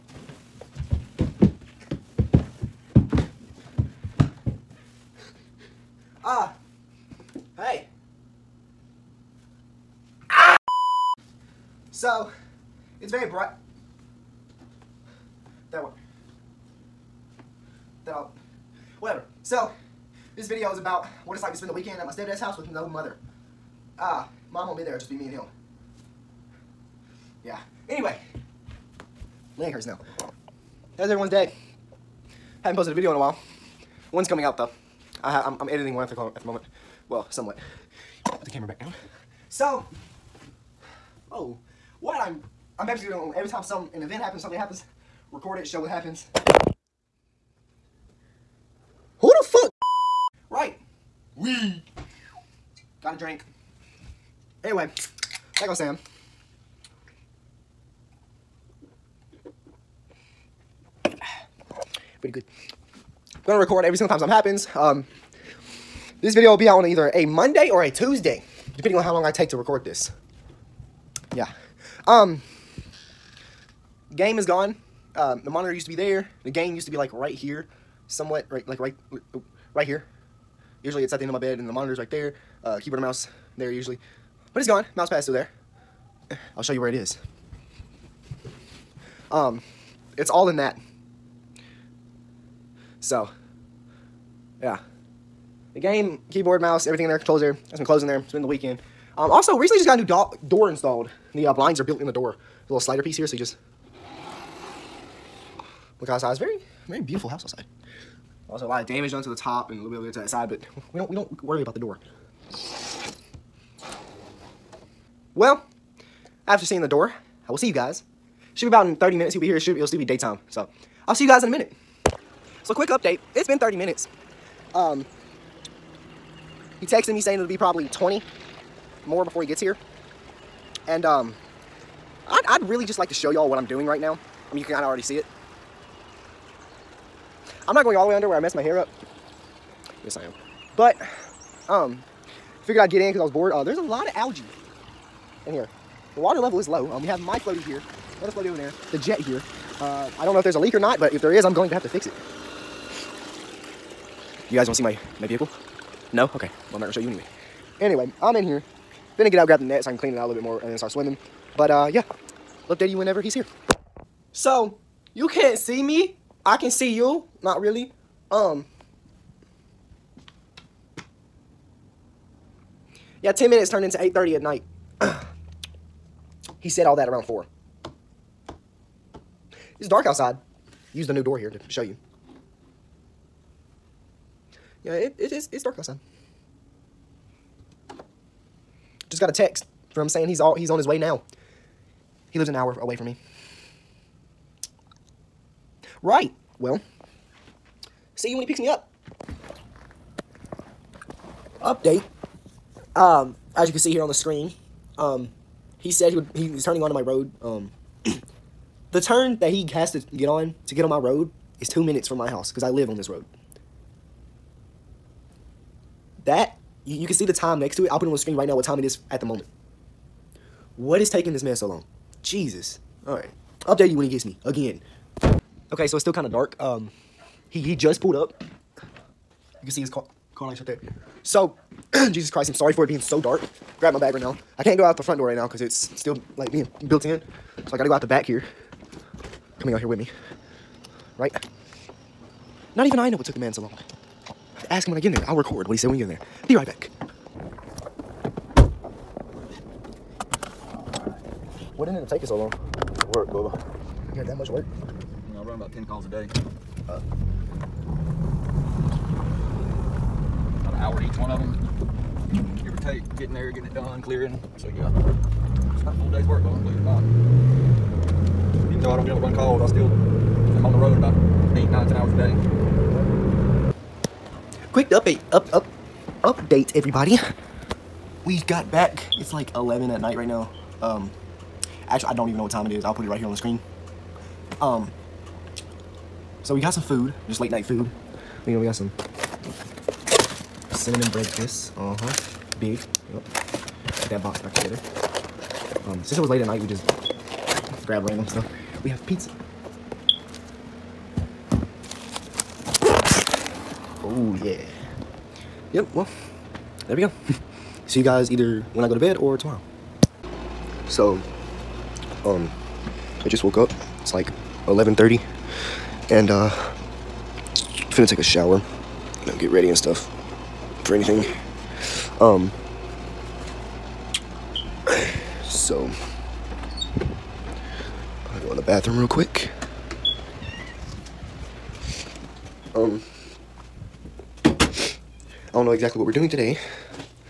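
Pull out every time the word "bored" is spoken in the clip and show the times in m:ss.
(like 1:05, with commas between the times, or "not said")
2:23.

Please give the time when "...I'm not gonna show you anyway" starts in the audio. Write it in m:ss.
2:36.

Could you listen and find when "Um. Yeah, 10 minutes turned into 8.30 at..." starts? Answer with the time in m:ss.
2:48.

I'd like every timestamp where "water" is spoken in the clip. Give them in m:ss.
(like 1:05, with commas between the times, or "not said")
2:26.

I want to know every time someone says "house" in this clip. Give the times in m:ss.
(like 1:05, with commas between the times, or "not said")
0:22, 1:47, 3:32.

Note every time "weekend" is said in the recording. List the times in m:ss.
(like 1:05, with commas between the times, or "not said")
0:21, 1:38.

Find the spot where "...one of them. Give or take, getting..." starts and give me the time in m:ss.
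4:21.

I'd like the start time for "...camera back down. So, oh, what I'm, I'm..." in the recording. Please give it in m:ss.
0:38.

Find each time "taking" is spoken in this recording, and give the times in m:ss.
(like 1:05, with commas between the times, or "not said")
3:41, 4:12.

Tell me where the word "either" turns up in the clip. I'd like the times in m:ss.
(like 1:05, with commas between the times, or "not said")
1:06, 5:08.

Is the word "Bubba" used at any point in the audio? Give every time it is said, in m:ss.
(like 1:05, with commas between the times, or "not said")
4:13, 4:26.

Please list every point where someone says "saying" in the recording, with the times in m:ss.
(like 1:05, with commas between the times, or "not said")
2:07, 3:10.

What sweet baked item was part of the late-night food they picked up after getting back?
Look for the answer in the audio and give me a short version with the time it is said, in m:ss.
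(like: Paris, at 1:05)
Cinnamon bread twist, at 4:50.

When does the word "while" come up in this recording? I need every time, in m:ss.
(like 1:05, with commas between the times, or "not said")
0:33.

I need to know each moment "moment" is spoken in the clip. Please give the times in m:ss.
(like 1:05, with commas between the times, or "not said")
0:36, 3:39.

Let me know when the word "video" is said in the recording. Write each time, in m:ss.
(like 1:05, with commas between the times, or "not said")
0:20, 0:32, 1:06.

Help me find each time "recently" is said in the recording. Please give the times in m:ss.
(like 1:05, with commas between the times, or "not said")
1:39.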